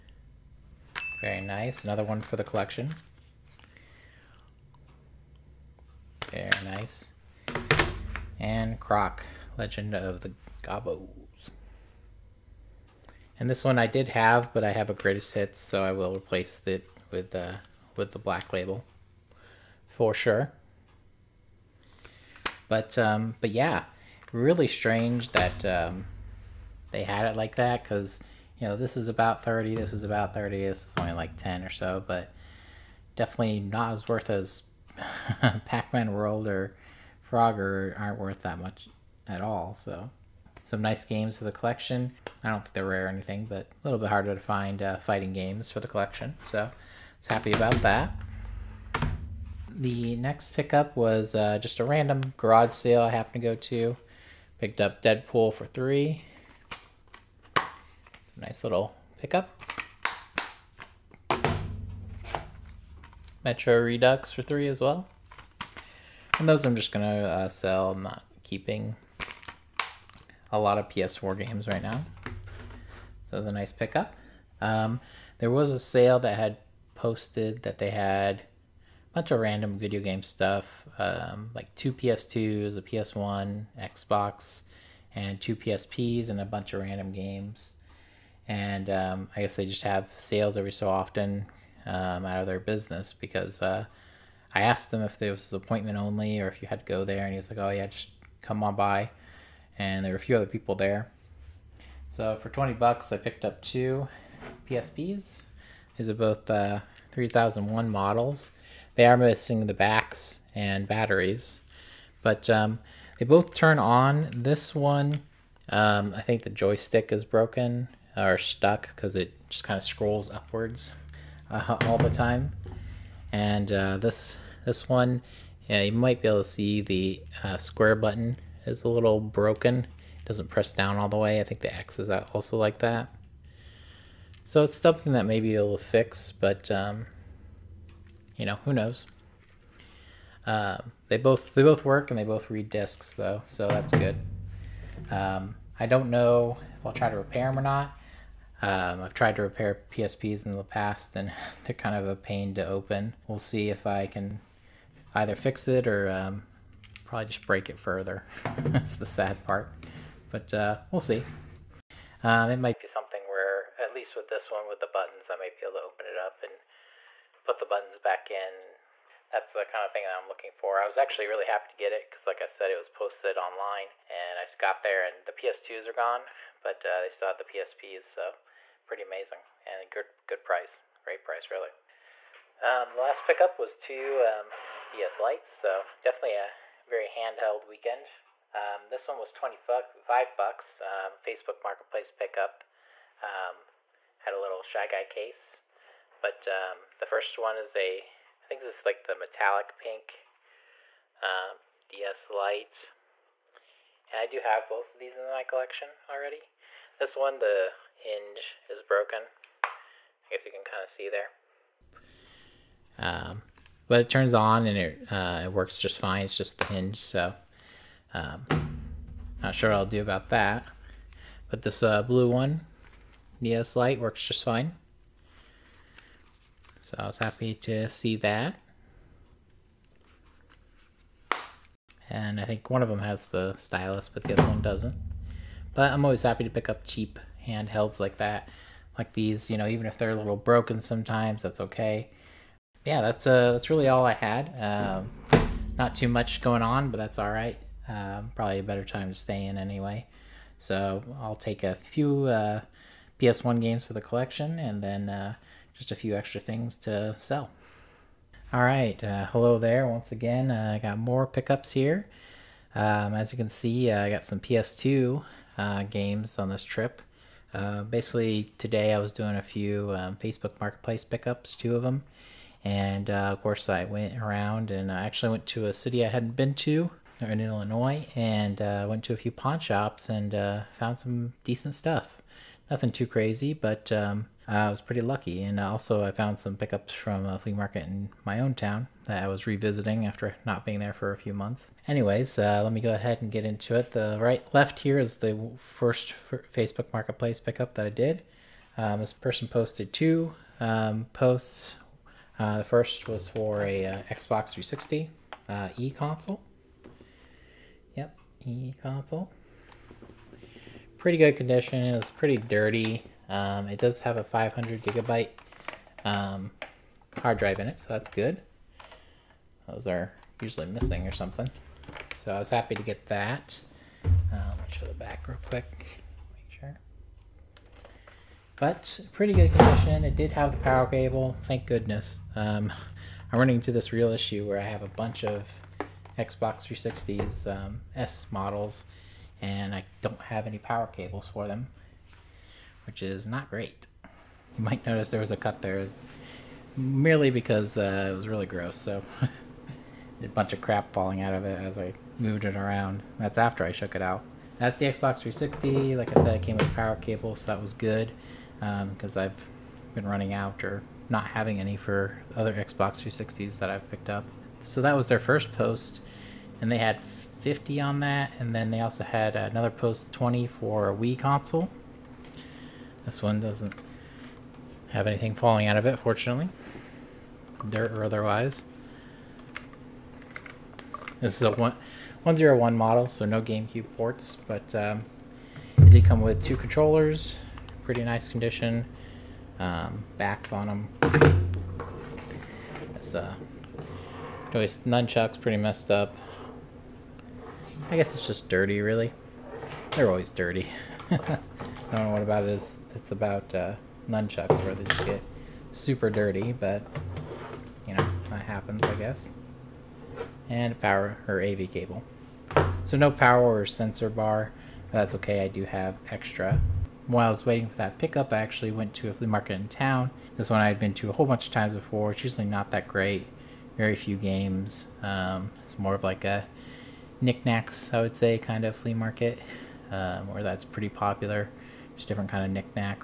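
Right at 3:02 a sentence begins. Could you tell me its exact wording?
Um, the last pickup was two um, DS Lites, so definitely a very handheld weekend.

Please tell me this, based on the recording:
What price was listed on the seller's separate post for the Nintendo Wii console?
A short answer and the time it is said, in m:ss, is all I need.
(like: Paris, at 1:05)
$20, at 6:10.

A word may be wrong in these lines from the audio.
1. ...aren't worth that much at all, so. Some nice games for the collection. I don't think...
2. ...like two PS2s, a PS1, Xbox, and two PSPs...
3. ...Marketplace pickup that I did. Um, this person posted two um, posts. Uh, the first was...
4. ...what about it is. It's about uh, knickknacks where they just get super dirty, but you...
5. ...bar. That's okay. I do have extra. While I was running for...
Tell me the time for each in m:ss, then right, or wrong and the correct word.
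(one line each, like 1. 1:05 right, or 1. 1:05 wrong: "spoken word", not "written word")
1. 0:38 right
2. 1:21 right
3. 4:56 right
4. 6:42 wrong: "nunchucks", not "knickknacks"
5. 6:54 wrong: "waiting", not "running".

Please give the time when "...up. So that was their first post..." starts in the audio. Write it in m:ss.
6:04.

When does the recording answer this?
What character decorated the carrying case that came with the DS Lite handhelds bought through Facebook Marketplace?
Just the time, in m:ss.
3:14.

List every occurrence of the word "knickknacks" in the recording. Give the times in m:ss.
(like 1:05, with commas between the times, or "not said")
7:07, 7:12.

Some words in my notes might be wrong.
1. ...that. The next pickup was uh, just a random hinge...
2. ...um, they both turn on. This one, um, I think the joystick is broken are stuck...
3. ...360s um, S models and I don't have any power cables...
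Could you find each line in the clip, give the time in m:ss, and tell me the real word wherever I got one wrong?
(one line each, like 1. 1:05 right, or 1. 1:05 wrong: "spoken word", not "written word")
1. 0:47 wrong: "garage", not "hinge"
2. 1:52 right
3. 5:36 right.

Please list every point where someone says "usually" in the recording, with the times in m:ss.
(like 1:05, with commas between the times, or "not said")
5:20, 7:02.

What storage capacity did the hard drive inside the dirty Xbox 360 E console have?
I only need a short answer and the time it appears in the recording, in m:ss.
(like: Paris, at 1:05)
500 GB, at 5:14.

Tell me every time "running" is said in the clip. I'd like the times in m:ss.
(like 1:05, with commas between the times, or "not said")
5:33, 6:00.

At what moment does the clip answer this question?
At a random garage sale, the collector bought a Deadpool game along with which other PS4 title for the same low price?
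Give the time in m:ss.
1:03.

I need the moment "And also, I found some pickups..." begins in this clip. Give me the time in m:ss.
4:45.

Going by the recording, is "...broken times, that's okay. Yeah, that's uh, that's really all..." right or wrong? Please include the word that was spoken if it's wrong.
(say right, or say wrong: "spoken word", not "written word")
wrong: "sometimes", not "times".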